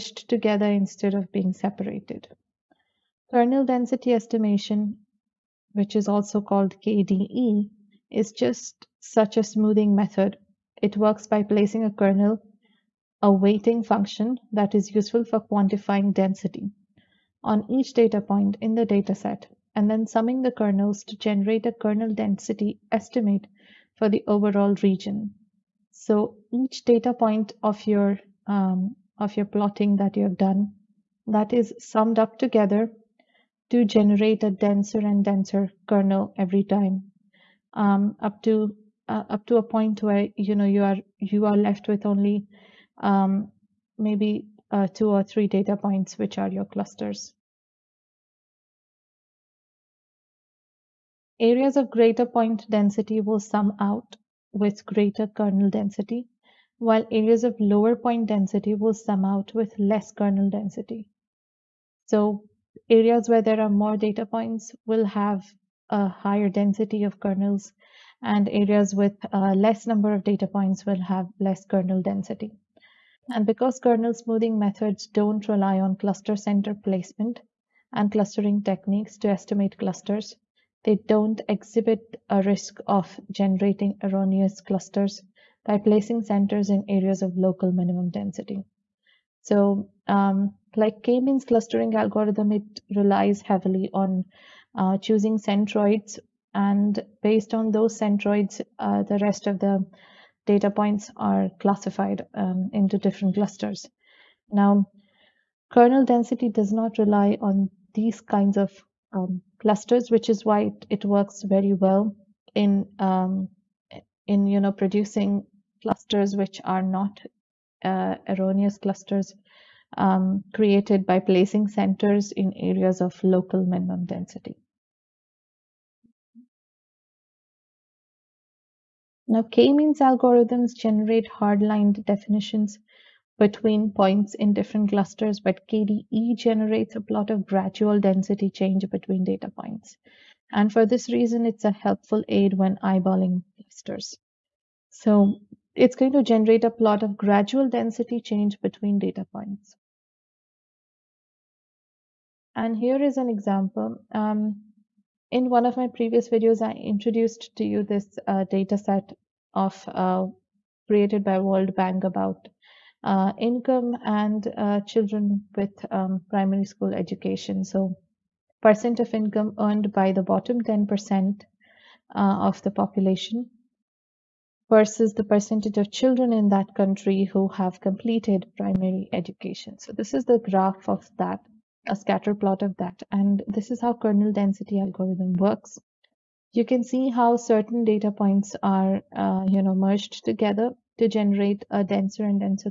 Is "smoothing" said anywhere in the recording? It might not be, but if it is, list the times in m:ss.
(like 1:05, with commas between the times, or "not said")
0:09, 1:14.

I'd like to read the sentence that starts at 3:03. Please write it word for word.
And this is how kernel density algorithm works.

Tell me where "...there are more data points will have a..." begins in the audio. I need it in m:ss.
1:03.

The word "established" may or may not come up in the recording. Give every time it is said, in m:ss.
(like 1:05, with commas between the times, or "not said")
not said.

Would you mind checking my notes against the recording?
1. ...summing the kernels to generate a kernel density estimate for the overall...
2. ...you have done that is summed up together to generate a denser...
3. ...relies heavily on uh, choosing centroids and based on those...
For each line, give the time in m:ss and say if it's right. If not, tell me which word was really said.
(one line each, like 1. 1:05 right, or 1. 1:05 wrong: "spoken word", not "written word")
1. 0:20 right
2. 0:30 right
3. 1:32 right.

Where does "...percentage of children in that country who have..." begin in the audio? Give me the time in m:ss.
2:55.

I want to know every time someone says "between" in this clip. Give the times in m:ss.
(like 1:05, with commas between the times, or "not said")
2:13, 2:18, 2:28.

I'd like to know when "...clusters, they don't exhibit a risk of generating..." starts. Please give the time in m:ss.
1:19.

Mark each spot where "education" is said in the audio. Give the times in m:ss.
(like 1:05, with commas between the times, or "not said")
2:46, 2:59.